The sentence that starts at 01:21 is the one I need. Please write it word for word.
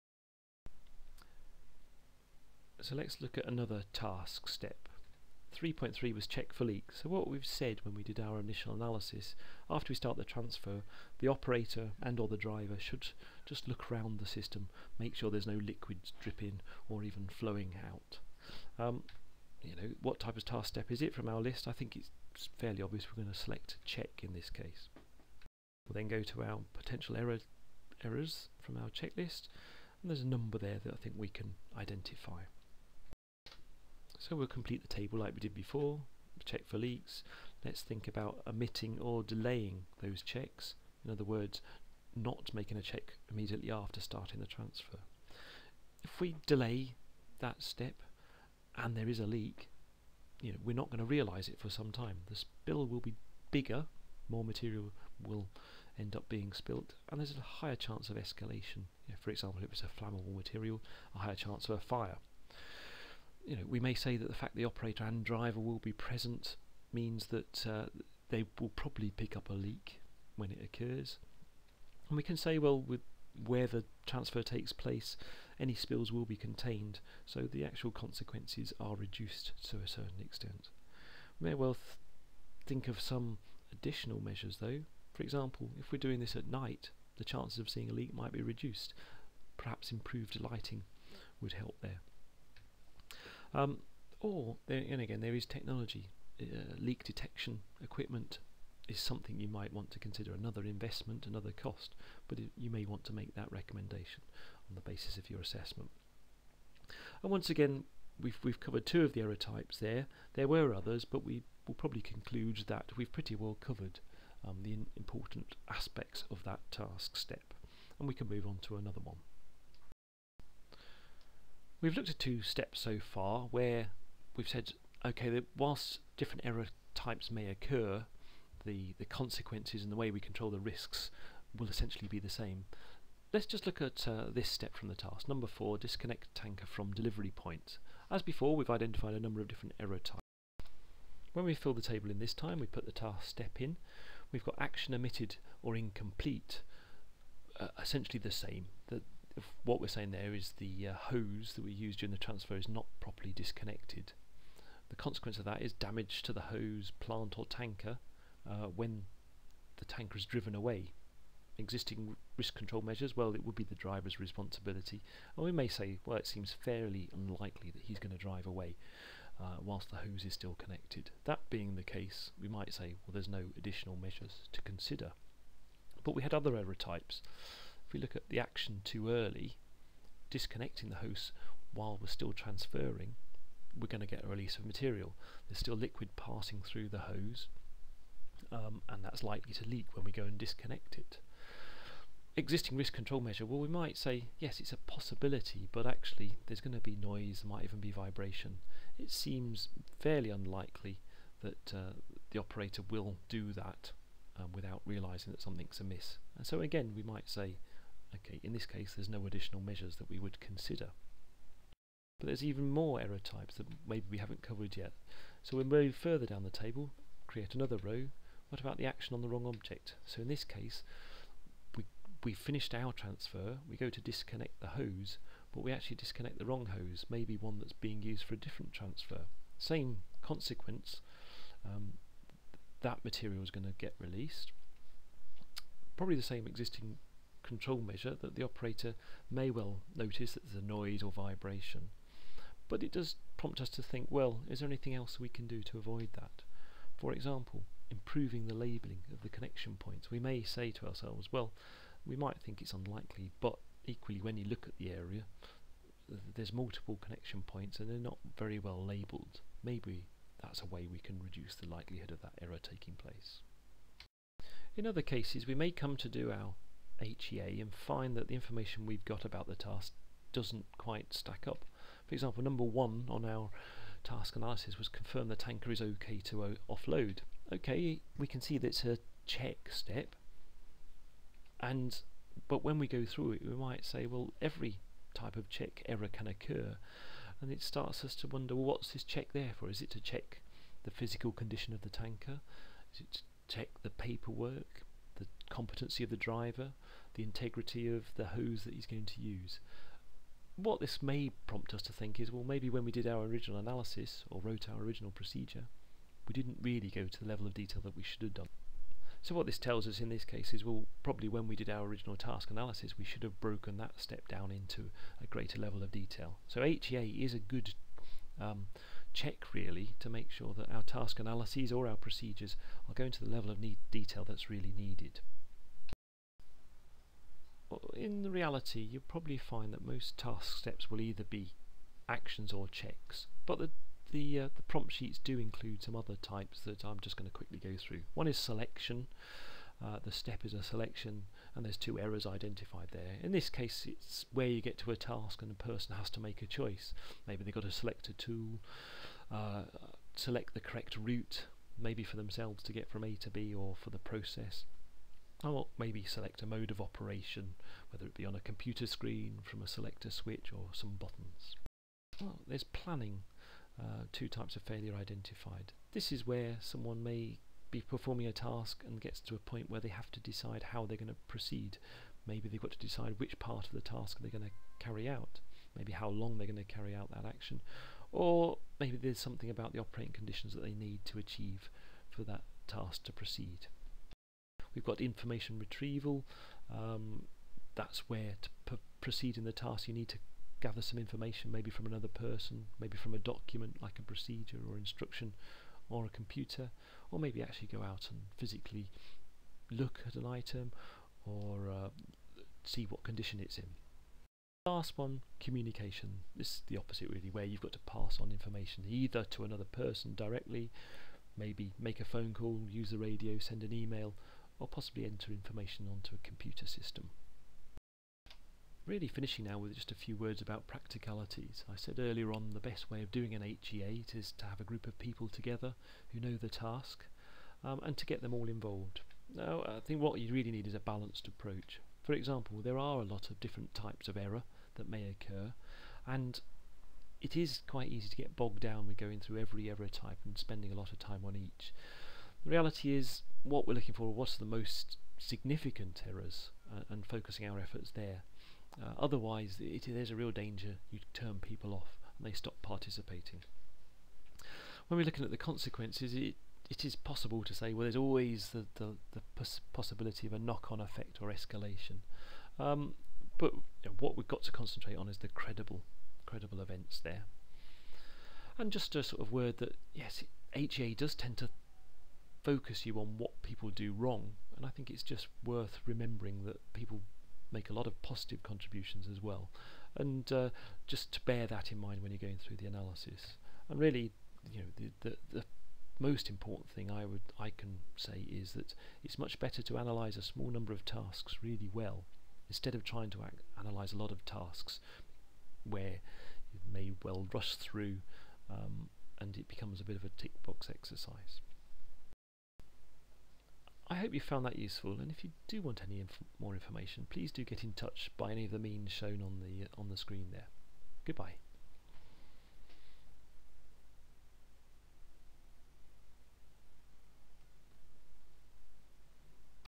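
We may well th think of some additional measures, though.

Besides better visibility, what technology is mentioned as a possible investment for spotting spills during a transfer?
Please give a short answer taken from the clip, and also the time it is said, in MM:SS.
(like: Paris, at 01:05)
Leak detection equipment, at 01:36.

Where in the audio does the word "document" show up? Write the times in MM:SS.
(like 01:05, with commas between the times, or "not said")
06:33.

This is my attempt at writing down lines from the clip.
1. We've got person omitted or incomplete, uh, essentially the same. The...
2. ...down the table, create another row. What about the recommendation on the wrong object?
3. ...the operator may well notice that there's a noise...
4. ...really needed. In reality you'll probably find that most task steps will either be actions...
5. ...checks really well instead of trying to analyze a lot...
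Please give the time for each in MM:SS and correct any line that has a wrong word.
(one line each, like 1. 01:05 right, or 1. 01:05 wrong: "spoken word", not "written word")
1. 02:24 wrong: "action", not "person"
2. 03:36 wrong: "action", not "recommendation"
3. 03:58 right
4. 05:24 right
5. 08:10 wrong: "tasks", not "checks".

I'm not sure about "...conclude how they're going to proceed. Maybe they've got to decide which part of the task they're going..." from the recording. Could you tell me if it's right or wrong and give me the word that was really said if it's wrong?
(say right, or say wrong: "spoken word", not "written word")
wrong: "decide", not "conclude".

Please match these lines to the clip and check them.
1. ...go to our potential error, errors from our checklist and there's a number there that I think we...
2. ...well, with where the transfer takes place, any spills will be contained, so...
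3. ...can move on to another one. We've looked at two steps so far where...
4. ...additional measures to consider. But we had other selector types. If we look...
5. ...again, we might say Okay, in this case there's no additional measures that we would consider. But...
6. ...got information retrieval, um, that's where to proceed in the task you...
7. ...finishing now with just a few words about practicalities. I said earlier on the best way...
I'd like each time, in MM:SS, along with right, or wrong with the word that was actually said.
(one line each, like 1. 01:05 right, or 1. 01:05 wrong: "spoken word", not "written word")
1. 00:26 right
2. 01:12 right
3. 01:58 right
4. 02:53 wrong: "error", not "selector"
5. 03:26 right
6. 06:24 right
7. 06:59 right.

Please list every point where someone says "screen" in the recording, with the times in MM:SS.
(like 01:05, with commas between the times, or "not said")
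05:58, 08:29.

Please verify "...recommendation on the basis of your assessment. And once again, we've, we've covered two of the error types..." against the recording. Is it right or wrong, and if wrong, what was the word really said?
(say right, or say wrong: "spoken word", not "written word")
right.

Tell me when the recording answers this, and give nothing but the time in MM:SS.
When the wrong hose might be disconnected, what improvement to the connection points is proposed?
04:07.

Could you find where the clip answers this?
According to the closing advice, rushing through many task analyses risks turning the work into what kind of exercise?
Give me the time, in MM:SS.
08:20.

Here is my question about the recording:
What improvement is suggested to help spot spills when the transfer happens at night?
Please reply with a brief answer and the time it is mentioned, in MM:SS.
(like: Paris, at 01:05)
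Improved lighting, at 01:29.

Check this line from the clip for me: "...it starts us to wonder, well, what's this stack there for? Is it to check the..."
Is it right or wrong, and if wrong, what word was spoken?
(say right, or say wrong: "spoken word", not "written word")
wrong: "check", not "stack".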